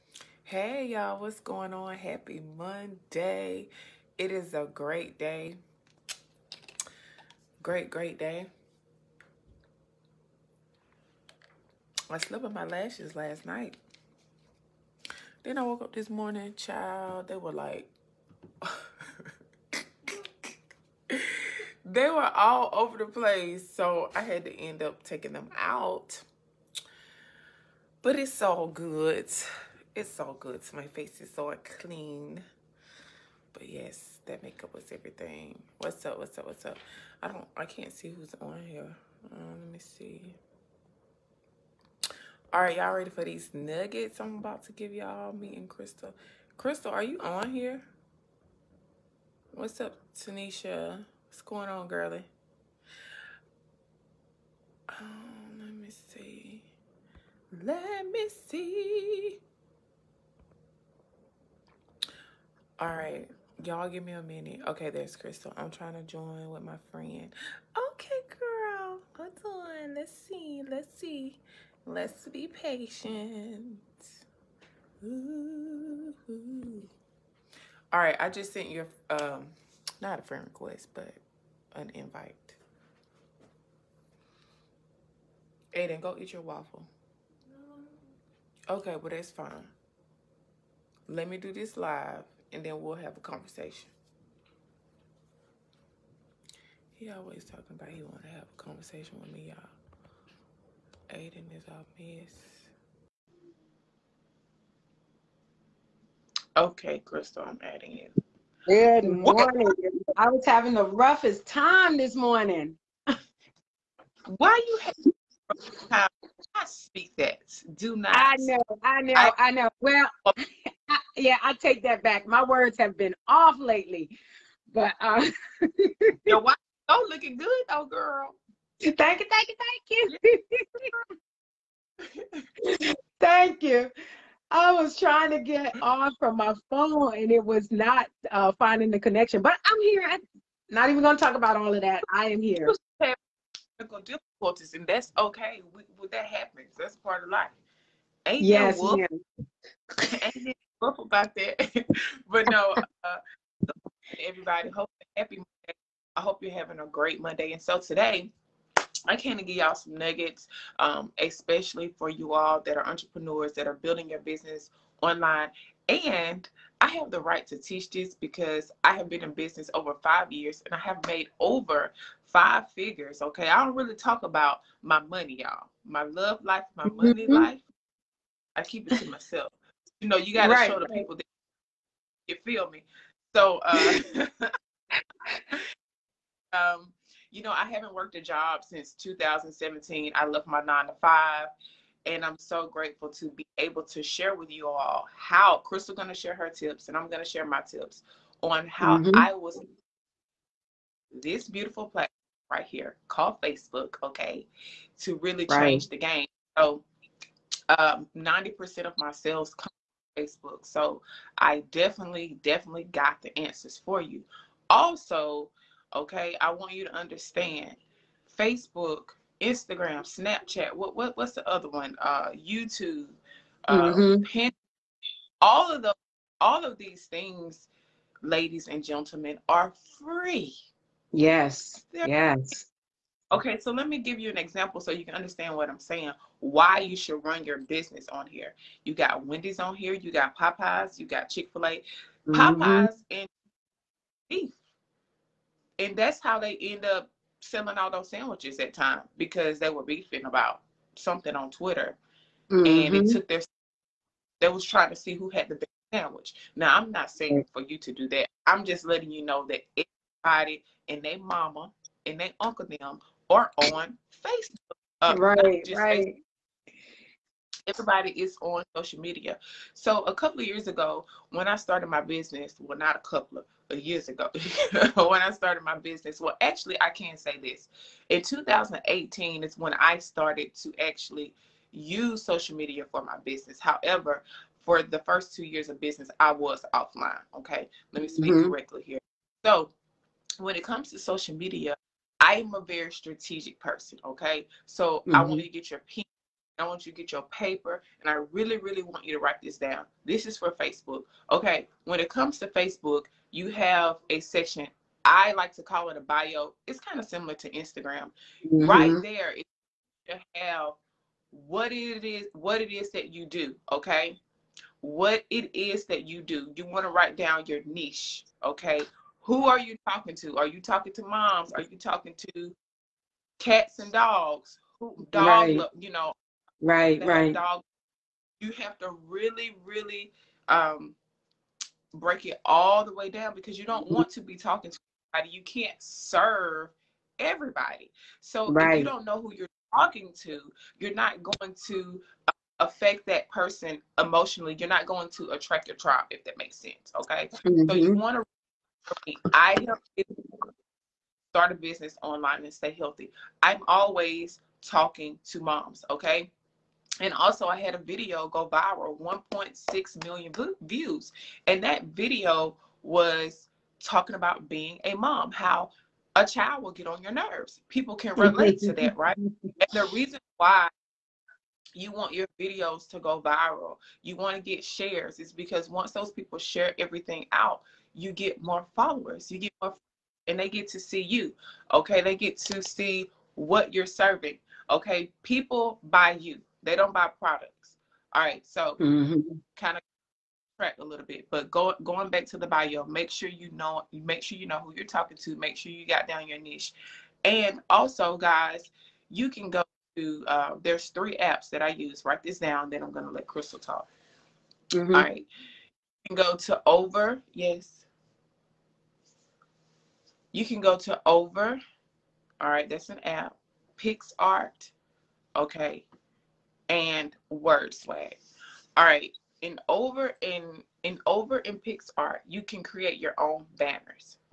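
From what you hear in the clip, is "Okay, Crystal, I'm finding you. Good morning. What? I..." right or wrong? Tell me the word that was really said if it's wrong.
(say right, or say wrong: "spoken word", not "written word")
wrong: "adding", not "finding".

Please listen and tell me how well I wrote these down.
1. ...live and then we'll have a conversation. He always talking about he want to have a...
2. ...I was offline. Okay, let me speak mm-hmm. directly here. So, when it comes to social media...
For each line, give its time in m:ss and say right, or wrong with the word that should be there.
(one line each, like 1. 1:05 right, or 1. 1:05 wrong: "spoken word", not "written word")
1. 1:31 right
2. 4:46 right.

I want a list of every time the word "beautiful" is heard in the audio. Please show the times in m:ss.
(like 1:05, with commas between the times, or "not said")
3:21.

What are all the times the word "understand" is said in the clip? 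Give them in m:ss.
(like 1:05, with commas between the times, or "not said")
3:36, 3:55.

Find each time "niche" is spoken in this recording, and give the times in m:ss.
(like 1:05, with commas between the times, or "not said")
5:17, 6:36.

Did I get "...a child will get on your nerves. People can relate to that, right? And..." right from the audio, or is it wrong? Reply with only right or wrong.
right.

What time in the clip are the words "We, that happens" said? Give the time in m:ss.
2:25.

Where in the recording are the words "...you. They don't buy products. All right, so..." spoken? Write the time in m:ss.
6:26.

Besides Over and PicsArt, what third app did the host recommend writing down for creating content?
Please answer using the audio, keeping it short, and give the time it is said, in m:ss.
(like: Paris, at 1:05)
Word Swag, at 6:57.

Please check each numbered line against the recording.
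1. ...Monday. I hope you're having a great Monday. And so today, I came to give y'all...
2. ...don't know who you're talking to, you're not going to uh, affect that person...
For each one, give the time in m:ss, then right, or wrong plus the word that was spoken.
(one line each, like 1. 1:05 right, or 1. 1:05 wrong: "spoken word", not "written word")
1. 2:35 right
2. 5:38 right.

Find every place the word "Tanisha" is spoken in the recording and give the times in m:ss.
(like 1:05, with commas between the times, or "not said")
0:50.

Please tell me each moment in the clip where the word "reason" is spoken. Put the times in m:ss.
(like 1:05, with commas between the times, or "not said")
6:09.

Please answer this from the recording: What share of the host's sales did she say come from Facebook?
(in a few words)
90%.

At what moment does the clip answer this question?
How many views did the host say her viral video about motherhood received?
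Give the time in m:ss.
5:58.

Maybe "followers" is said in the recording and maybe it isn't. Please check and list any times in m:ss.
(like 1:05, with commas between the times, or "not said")
6:18.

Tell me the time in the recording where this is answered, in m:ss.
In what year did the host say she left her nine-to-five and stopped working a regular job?
3:08.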